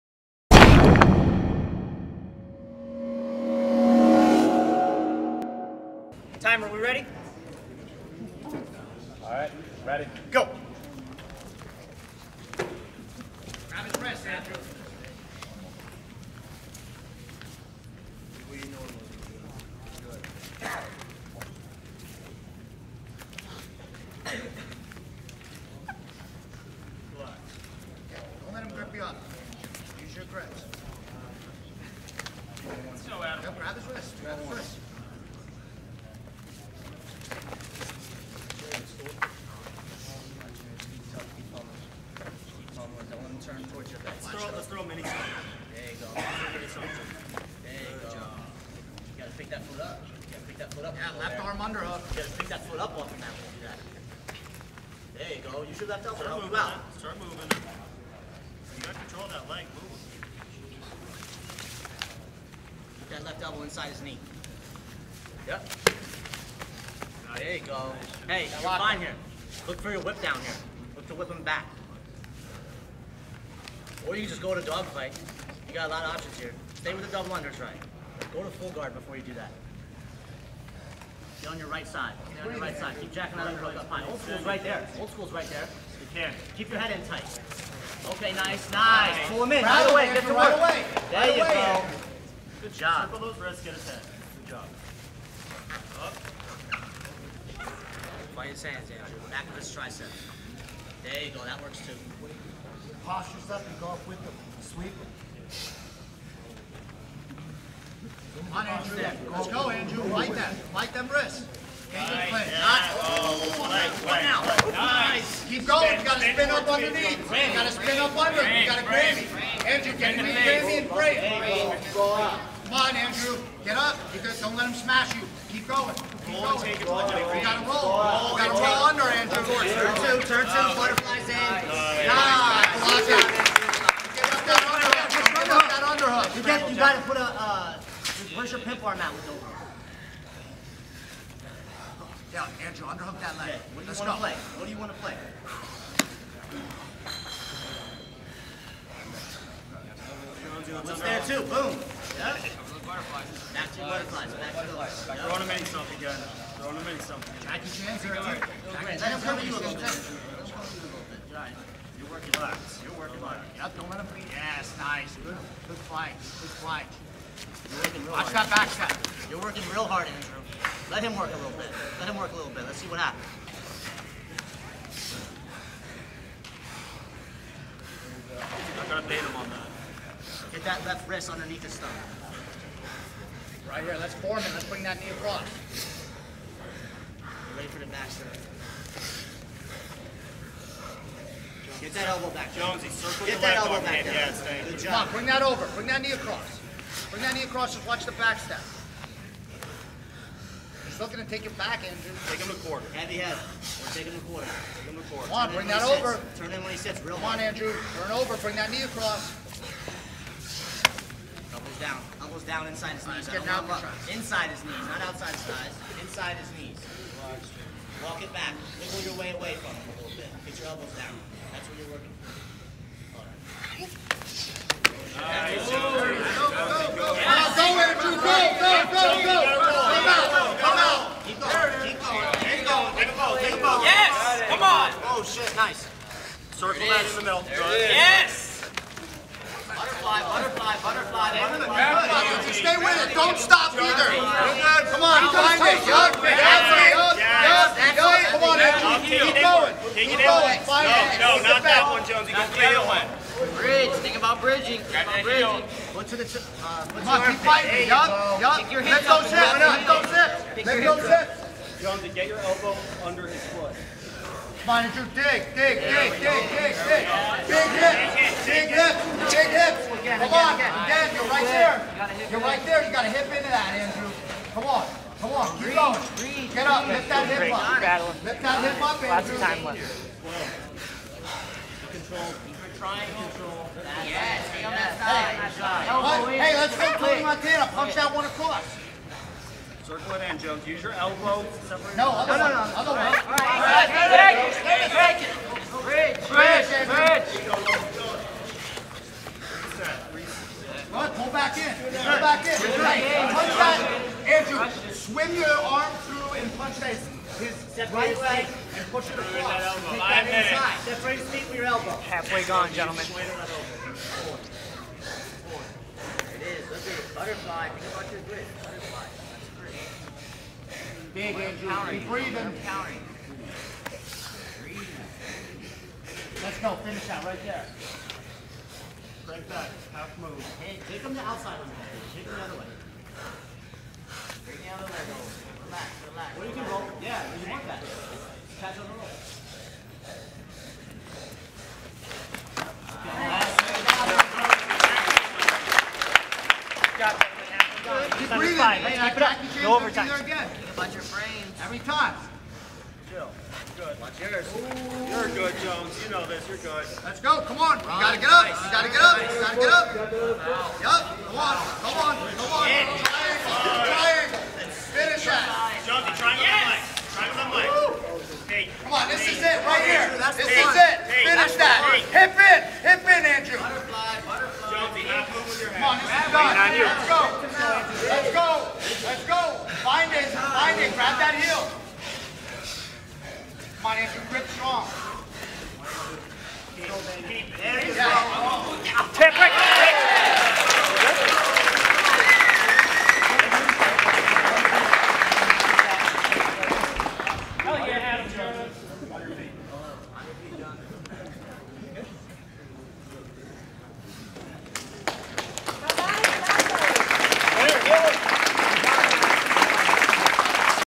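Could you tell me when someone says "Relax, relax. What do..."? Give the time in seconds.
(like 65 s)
335 s.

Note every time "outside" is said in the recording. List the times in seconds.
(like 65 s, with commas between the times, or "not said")
215 s, 331 s.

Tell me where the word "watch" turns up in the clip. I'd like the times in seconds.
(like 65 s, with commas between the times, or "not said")
168 s, 197 s, 353 s.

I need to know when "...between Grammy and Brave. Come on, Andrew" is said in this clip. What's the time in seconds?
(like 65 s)
120 s.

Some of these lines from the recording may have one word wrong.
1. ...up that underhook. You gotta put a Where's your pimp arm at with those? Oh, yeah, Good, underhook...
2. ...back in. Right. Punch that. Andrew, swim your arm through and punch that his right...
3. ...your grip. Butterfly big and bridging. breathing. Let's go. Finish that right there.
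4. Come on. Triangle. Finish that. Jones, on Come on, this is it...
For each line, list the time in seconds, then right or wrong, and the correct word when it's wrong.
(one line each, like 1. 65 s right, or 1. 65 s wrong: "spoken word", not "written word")
1. 135 s wrong: "Andrew", not "Good"
2. 301 s right
3. 318 s wrong: "countering", not "bridging"
4. 362 s right.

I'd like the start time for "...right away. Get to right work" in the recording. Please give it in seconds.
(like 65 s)
89 s.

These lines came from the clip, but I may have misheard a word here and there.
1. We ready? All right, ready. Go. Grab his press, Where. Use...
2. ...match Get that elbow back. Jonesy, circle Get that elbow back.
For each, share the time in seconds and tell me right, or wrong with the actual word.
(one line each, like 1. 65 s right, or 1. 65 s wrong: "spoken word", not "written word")
1. 6 s wrong: "Andrew", not "Where"
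2. 187 s right.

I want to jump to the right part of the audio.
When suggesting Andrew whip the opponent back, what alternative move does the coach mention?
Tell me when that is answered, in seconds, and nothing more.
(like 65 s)
74 s.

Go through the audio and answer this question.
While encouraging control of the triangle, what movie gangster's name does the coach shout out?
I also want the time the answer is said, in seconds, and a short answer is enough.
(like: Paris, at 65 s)
Tony Montana, at 287 s.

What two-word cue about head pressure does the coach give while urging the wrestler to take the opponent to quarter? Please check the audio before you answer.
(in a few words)
Heavy head.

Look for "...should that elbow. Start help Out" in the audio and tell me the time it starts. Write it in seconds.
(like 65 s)
55 s.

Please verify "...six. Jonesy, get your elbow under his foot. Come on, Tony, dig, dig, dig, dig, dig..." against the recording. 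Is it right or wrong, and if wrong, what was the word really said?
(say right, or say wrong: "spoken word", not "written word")
wrong: "Andrew", not "Tony".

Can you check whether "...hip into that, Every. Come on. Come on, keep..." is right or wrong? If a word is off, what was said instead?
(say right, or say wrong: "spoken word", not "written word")
wrong: "Andrew", not "Every".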